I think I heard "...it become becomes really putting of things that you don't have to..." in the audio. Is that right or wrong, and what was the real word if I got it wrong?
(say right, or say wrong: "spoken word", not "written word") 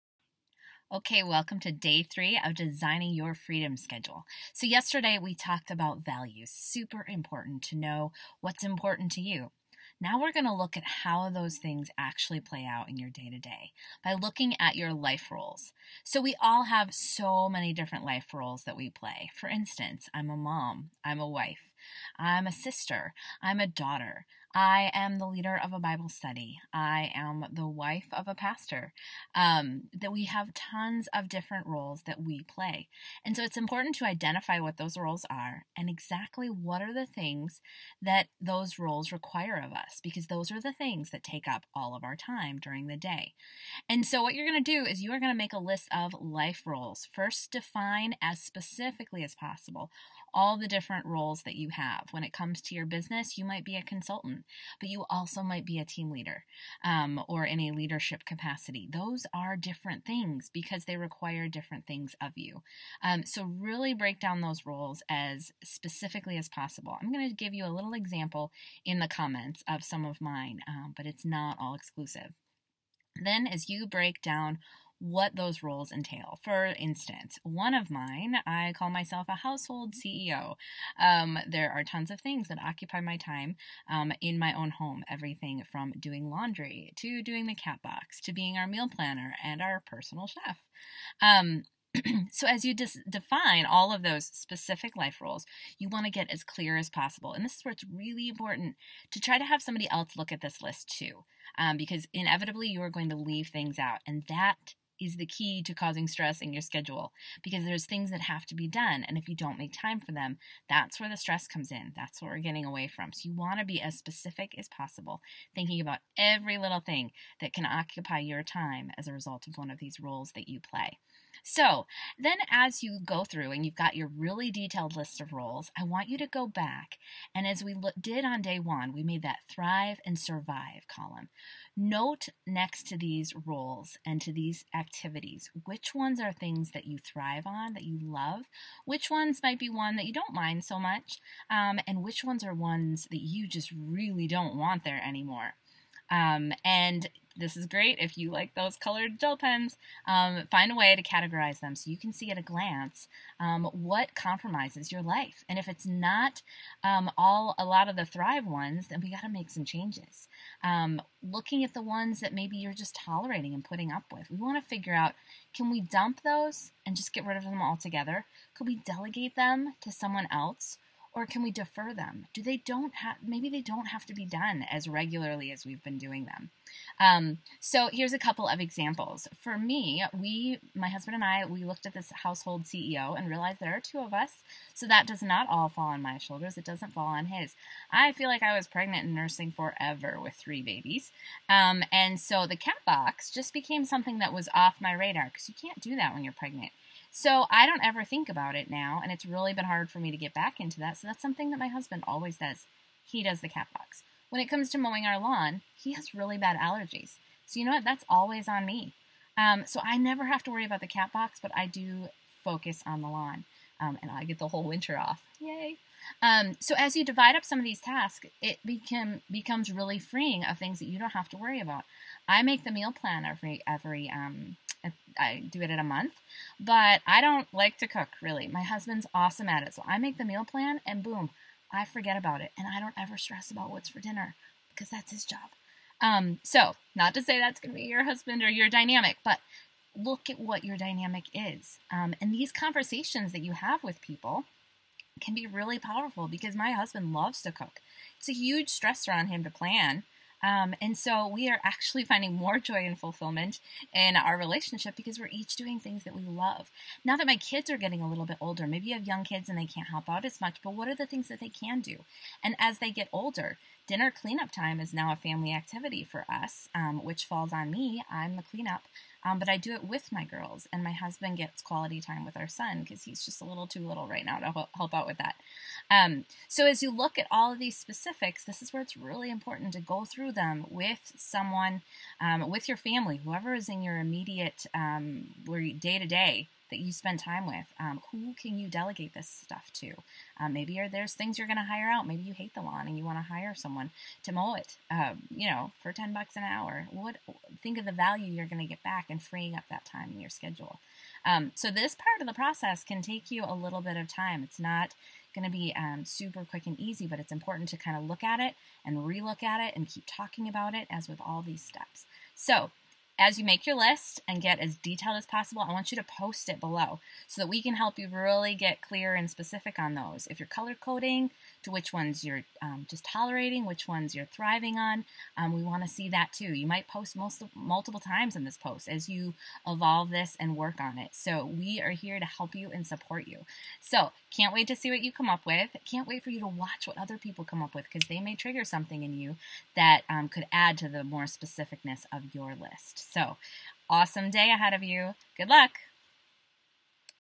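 wrong: "freeing", not "putting".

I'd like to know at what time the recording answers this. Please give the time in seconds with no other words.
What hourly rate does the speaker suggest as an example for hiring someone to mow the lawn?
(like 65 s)
295 s.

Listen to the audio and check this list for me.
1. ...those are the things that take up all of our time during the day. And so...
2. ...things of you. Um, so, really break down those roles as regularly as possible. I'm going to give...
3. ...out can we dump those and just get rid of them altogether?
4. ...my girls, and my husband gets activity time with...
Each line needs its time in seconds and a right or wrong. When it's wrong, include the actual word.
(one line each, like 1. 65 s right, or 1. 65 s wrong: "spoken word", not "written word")
1. 40 s right
2. 61 s wrong: "specifically", not "regularly"
3. 164 s right
4. 270 s wrong: "quality", not "activity".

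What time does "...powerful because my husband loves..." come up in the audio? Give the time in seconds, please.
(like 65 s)
245 s.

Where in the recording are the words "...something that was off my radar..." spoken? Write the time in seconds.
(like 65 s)
193 s.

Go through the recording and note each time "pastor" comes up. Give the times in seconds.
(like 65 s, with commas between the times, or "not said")
28 s.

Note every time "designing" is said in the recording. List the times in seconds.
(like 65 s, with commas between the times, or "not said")
2 s.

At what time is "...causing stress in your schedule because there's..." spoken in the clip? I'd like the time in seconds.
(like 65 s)
105 s.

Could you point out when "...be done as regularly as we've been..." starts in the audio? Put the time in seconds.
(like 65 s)
174 s.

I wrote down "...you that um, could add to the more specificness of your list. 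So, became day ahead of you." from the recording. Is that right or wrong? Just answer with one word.
wrong.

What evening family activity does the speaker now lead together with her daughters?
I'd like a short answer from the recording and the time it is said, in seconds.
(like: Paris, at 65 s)
Dinner cleanup, at 263 s.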